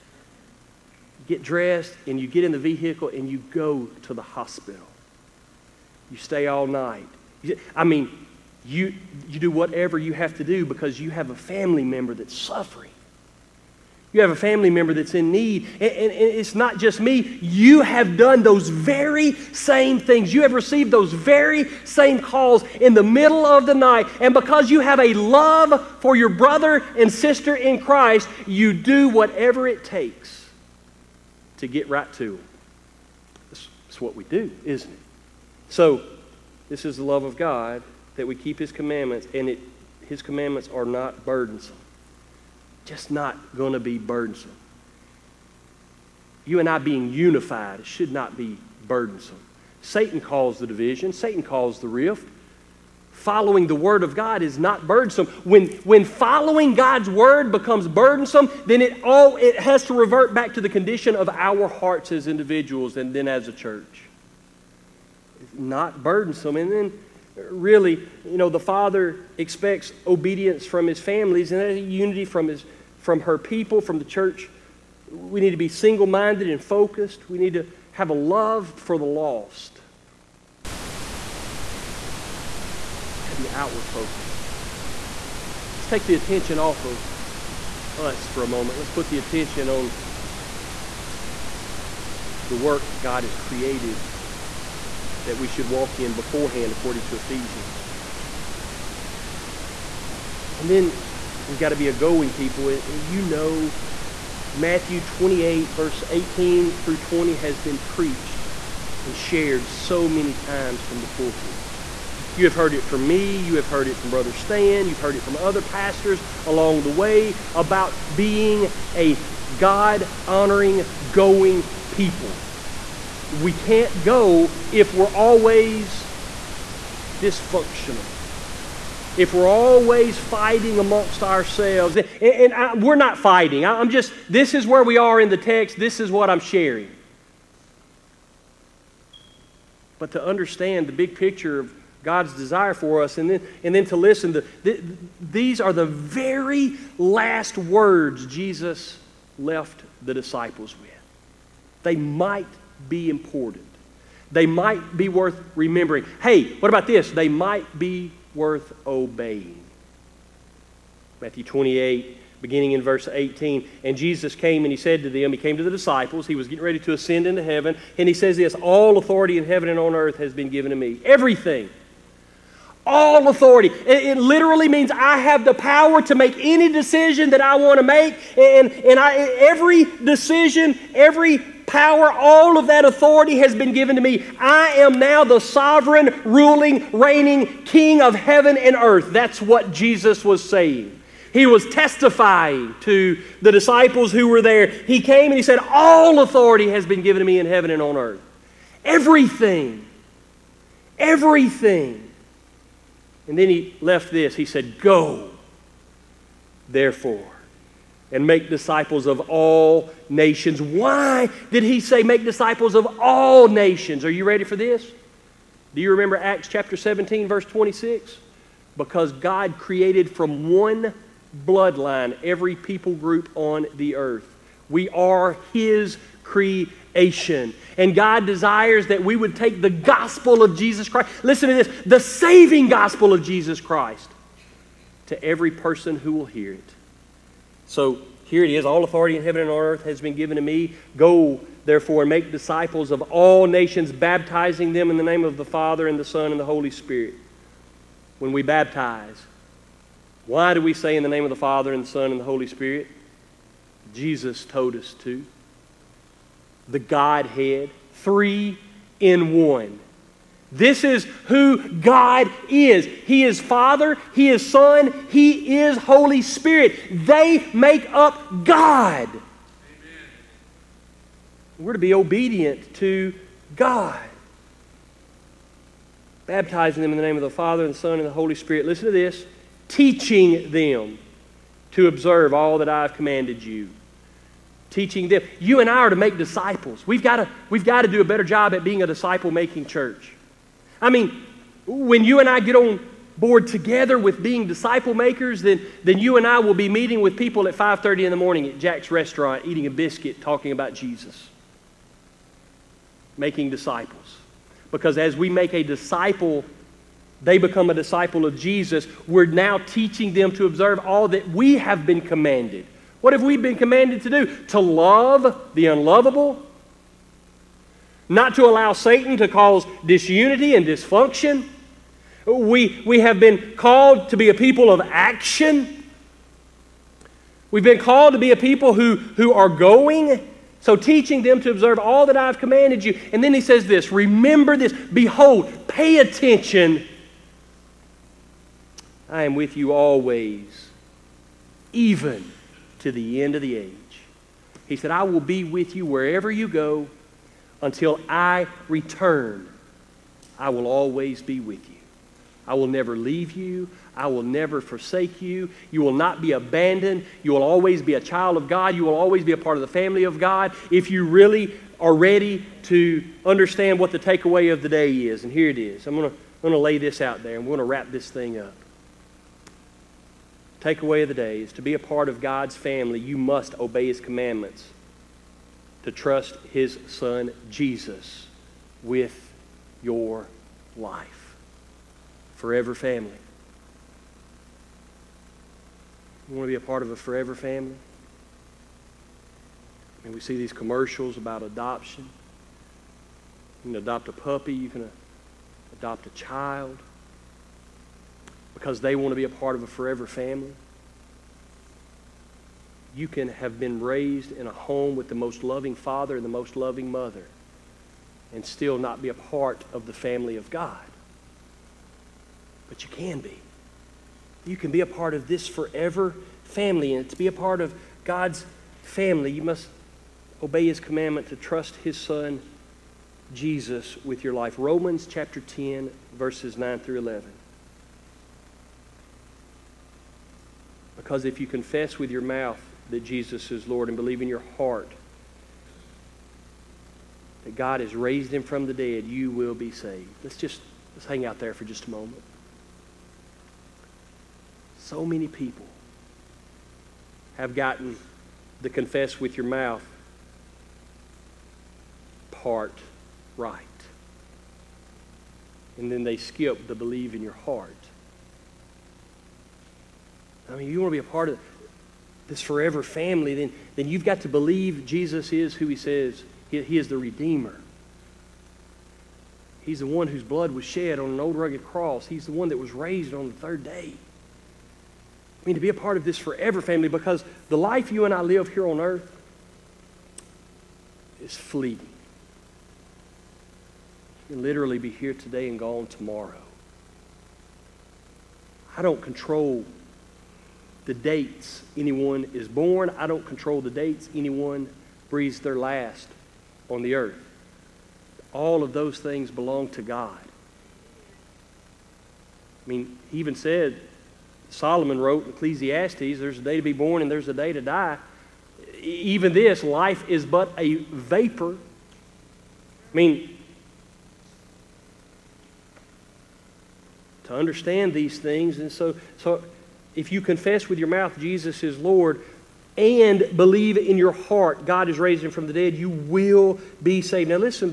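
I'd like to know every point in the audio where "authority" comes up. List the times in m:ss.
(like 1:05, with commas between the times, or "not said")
2:48, 2:53, 3:02, 3:16, 3:58.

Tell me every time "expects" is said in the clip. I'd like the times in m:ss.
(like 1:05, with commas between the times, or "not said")
1:09.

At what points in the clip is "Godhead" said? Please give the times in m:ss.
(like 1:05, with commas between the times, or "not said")
4:16.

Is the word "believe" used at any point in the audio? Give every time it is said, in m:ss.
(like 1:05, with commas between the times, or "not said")
7:13, 7:36, 7:44, 8:43.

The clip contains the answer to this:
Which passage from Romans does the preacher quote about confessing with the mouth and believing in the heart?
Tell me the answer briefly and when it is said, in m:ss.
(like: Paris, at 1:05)
Romans 10:9-11, at 7:04.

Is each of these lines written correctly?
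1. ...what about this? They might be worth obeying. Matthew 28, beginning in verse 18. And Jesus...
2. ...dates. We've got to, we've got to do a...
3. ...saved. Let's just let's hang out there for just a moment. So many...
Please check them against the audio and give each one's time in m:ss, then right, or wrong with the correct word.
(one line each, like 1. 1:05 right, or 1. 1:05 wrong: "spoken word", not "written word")
1. 2:36 right
2. 4:46 wrong: "disciples", not "dates"
3. 7:19 right.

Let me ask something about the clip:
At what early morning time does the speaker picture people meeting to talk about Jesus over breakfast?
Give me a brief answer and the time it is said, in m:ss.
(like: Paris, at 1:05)
5:30, at 4:57.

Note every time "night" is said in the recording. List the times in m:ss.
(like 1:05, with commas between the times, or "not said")
0:06, 0:23.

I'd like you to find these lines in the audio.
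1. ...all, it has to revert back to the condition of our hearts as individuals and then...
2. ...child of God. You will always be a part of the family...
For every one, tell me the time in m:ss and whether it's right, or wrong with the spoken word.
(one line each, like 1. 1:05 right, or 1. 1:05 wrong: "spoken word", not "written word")
1. 0:59 right
2. 5:58 right.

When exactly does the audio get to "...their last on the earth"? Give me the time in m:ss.
8:15.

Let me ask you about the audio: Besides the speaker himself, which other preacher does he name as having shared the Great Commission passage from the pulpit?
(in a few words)
Brother Stan.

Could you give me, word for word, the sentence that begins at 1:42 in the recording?
And you know, Matthew 28, verse 18 through 20, has been preached and shared so many times from the pulpit.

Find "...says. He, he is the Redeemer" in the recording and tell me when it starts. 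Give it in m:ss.
7:45.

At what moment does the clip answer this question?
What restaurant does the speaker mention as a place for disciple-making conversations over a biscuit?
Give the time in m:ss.
4:58.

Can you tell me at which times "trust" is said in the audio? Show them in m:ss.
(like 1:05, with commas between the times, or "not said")
6:15, 7:01.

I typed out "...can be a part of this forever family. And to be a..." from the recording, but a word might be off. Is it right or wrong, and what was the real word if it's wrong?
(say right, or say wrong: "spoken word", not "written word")
right.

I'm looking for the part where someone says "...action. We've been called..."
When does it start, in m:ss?
5:24.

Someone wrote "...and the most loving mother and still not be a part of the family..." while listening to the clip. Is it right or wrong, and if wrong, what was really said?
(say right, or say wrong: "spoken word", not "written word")
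right.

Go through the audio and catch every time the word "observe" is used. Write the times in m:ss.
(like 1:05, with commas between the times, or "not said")
4:41, 5:10, 5:31.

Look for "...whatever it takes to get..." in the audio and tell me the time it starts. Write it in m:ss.
0:29.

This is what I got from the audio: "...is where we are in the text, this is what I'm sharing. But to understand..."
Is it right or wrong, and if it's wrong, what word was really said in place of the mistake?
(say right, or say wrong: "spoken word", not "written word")
right.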